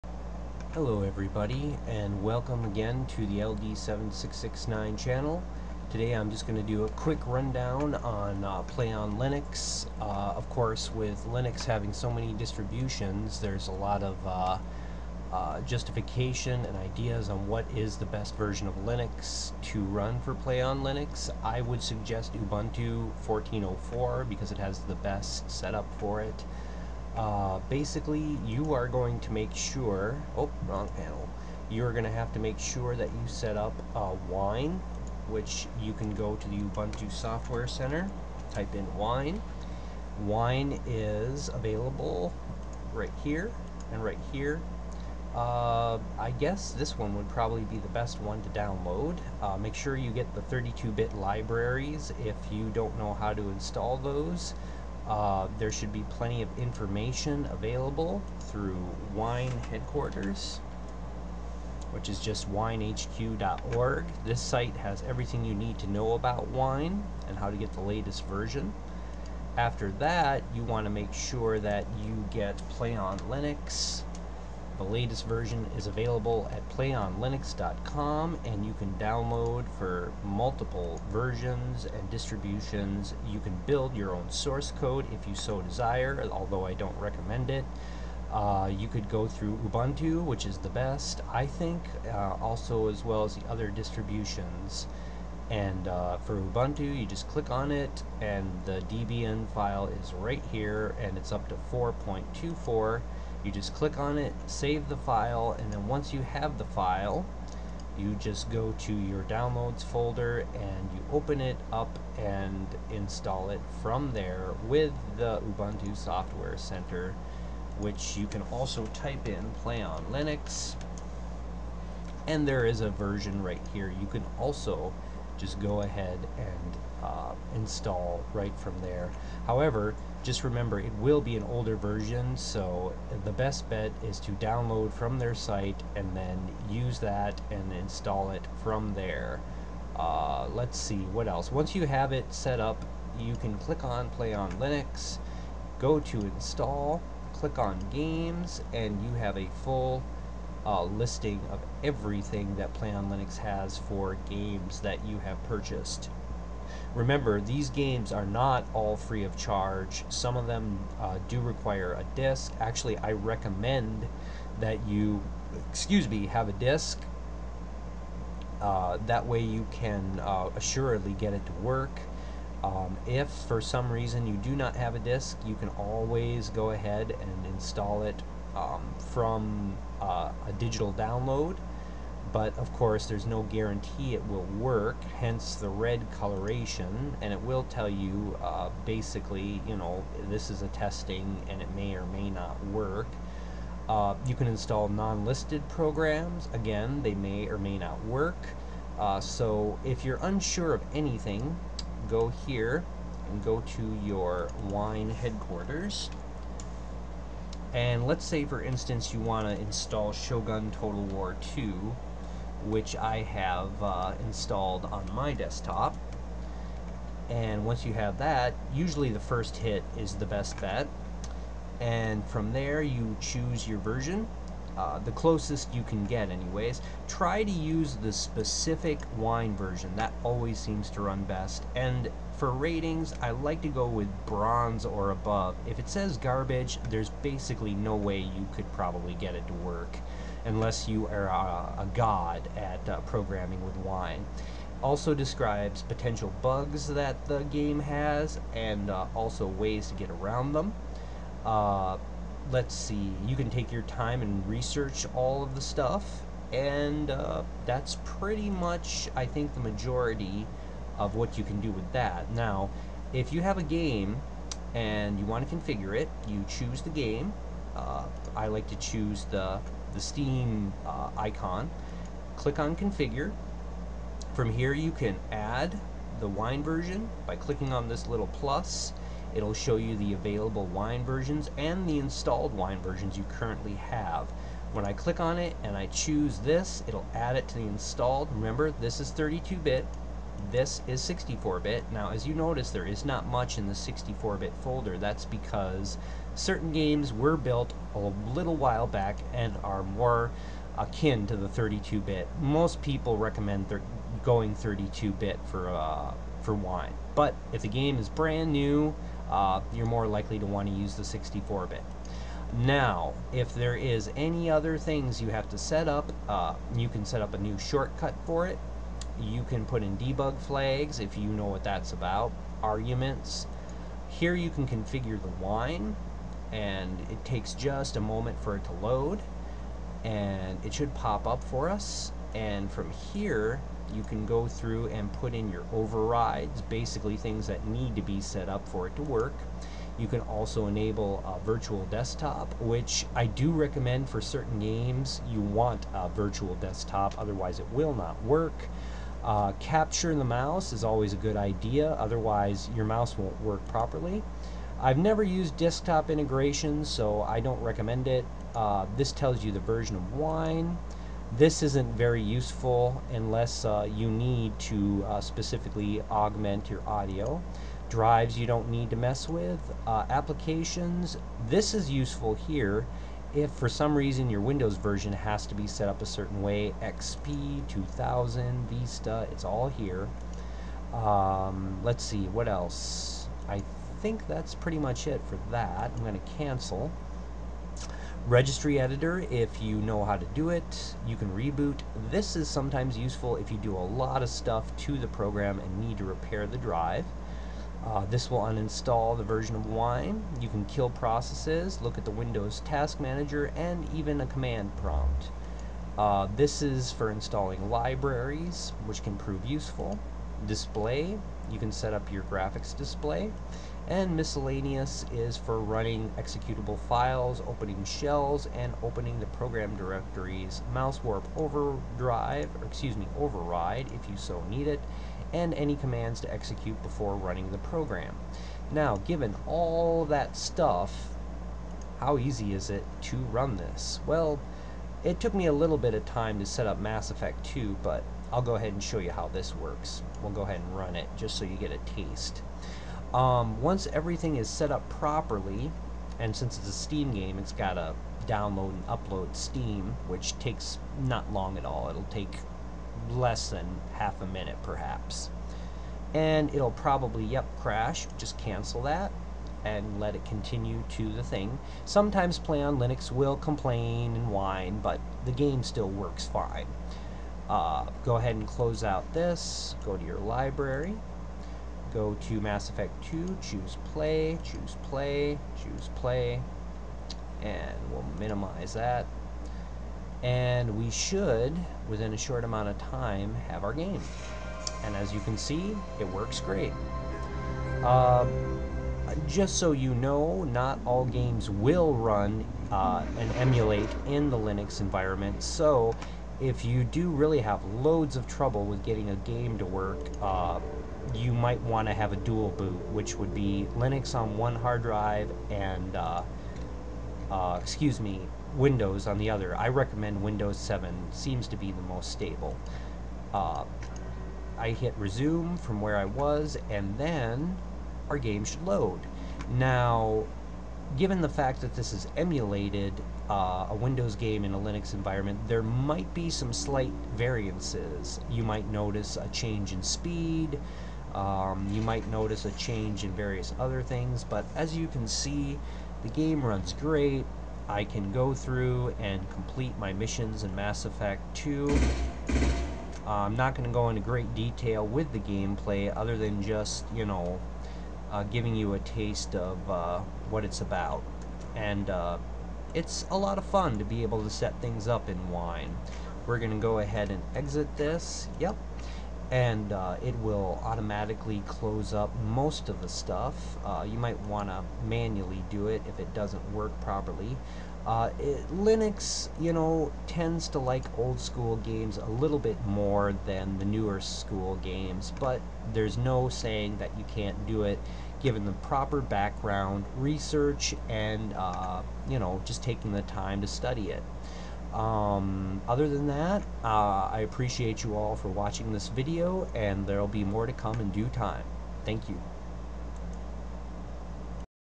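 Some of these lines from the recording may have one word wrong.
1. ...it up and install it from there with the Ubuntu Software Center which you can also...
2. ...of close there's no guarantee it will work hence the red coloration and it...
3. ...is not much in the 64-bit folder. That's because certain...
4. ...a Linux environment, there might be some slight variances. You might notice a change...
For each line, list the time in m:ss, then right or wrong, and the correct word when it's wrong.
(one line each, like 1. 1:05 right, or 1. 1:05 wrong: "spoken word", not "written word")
1. 1:51 right
2. 3:02 wrong: "course", not "close"
3. 4:52 right
4. 8:44 right.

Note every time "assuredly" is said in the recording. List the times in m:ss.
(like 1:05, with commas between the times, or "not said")
2:50.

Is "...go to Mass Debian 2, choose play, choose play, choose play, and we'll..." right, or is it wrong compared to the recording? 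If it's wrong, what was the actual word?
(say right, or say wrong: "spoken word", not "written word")
wrong: "Effect", not "Debian".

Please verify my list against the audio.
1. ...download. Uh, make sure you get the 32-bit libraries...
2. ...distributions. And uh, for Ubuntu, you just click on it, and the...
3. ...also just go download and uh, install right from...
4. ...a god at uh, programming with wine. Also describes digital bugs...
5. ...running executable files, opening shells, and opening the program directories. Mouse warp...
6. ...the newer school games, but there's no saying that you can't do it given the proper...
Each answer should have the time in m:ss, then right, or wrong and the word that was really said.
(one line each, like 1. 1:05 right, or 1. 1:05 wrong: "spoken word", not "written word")
1. 0:48 right
2. 1:33 right
3. 2:04 wrong: "ahead", not "download"
4. 4:01 wrong: "potential", not "digital"
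5. 6:55 right
6. 9:33 right.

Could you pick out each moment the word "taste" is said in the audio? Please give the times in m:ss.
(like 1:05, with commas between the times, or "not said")
7:21, 9:08.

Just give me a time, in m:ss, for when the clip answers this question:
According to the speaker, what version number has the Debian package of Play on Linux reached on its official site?
1:41.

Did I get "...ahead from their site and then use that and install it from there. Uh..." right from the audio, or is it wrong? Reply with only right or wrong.
wrong.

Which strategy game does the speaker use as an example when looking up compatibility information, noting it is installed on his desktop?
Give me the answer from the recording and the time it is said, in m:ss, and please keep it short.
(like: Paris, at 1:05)
Shogun Total War 2, at 3:30.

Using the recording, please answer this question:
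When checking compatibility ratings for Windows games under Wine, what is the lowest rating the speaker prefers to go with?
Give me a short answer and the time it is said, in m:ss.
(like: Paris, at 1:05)
bronze, at 3:54.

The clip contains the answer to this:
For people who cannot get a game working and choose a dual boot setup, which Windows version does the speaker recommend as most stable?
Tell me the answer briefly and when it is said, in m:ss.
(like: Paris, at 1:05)
Windows 7, at 8:30.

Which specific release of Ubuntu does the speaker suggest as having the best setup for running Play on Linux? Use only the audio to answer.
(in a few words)
14.04.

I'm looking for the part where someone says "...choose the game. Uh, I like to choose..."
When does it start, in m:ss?
4:26.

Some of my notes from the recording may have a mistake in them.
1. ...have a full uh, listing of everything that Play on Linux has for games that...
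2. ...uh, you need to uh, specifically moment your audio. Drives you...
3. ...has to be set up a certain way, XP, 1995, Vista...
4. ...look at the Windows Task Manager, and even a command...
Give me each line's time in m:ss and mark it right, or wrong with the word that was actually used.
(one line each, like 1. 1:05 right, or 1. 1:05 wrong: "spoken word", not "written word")
1. 2:29 right
2. 6:03 wrong: "augment", not "moment"
3. 6:15 wrong: "2000", not "1995"
4. 6:41 right.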